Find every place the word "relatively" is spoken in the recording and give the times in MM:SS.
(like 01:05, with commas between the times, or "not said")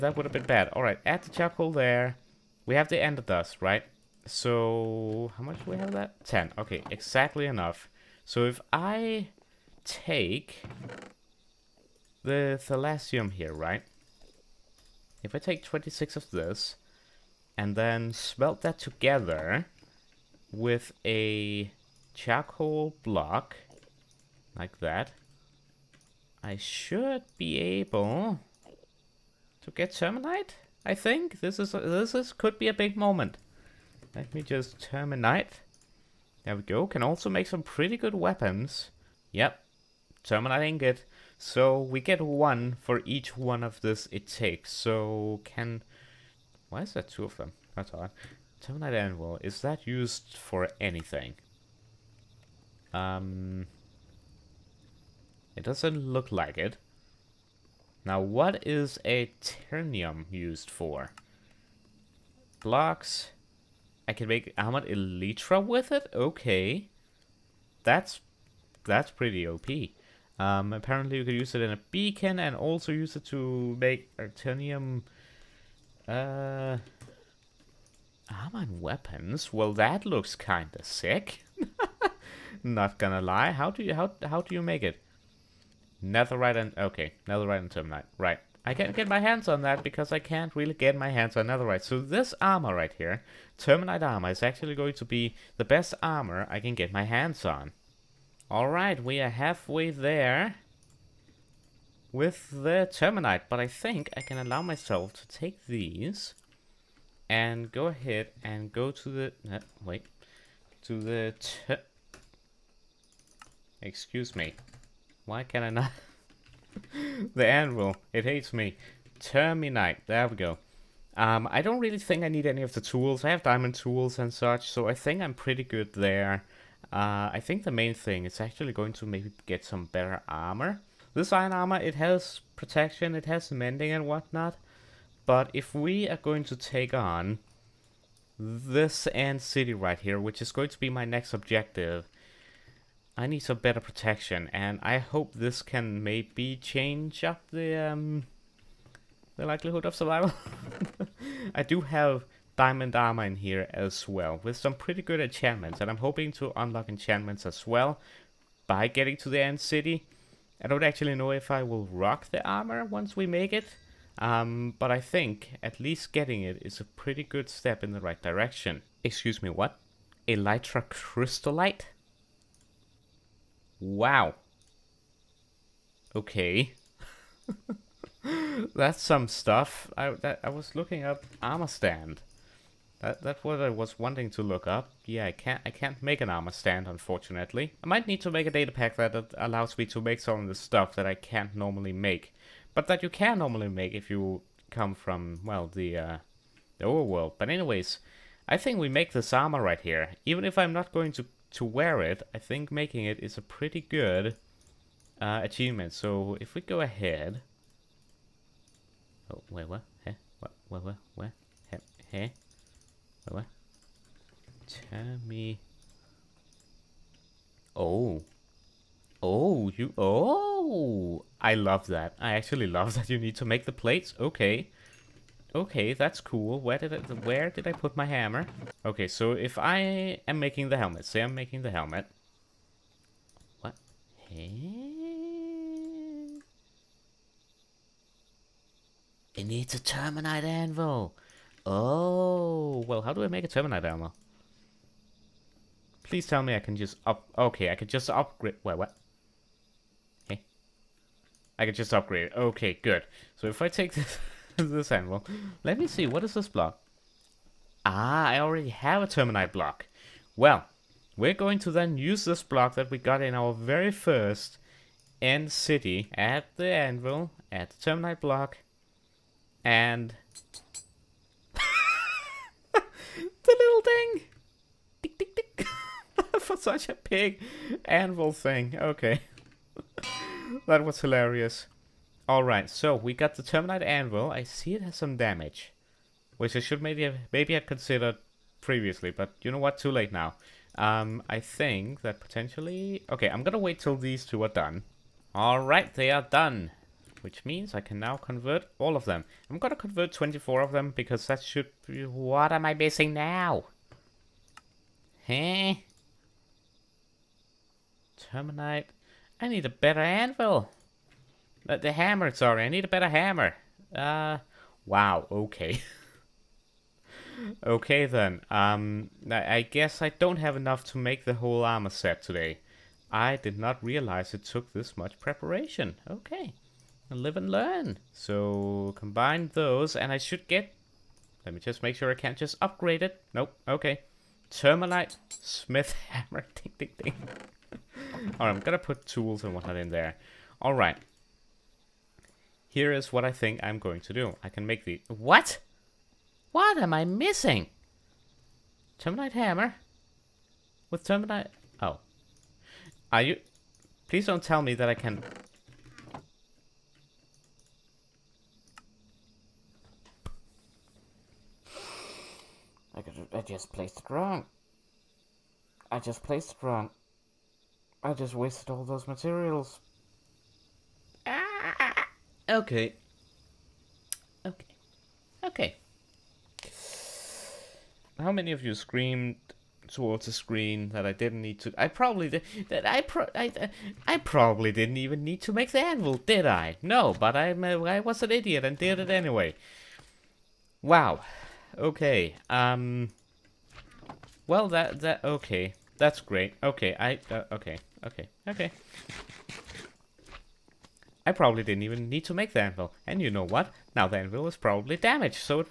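not said.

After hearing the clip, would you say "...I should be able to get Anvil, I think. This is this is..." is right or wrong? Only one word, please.
wrong.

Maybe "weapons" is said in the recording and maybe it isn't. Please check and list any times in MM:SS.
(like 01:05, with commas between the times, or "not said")
00:38, 01:18.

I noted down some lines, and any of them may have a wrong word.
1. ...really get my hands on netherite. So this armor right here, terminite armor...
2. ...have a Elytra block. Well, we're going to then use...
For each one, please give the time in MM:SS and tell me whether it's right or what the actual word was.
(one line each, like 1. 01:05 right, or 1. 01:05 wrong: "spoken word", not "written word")
1. 01:30 right
2. 04:18 wrong: "Terminite", not "Elytra".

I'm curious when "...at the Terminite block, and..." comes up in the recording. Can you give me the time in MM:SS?
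04:27.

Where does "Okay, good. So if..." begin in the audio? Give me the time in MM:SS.
04:12.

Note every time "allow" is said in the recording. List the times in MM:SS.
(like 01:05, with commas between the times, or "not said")
01:44, 03:09.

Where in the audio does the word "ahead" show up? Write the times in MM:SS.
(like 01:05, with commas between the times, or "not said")
01:47, 03:26.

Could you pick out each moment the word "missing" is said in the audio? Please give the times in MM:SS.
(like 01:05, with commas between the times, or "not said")
05:02, 05:47.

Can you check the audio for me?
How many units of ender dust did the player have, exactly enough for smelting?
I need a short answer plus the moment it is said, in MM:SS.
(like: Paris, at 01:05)
10, at 00:06.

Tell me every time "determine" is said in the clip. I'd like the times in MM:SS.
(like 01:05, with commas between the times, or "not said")
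not said.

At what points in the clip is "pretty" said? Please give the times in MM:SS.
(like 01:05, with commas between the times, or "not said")
00:37, 01:09, 02:05, 02:34, 02:46, 03:23.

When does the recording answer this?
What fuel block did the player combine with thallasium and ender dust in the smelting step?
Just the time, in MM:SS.
00:22.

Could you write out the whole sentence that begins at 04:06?
Please tell me I can just up...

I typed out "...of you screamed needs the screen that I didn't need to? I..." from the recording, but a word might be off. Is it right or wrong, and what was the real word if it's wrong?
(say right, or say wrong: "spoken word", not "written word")
wrong: "towards", not "needs".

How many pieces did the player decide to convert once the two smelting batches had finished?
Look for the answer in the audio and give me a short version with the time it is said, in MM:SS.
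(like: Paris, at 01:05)
24, at 05:00.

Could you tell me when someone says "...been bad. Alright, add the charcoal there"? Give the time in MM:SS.
00:00.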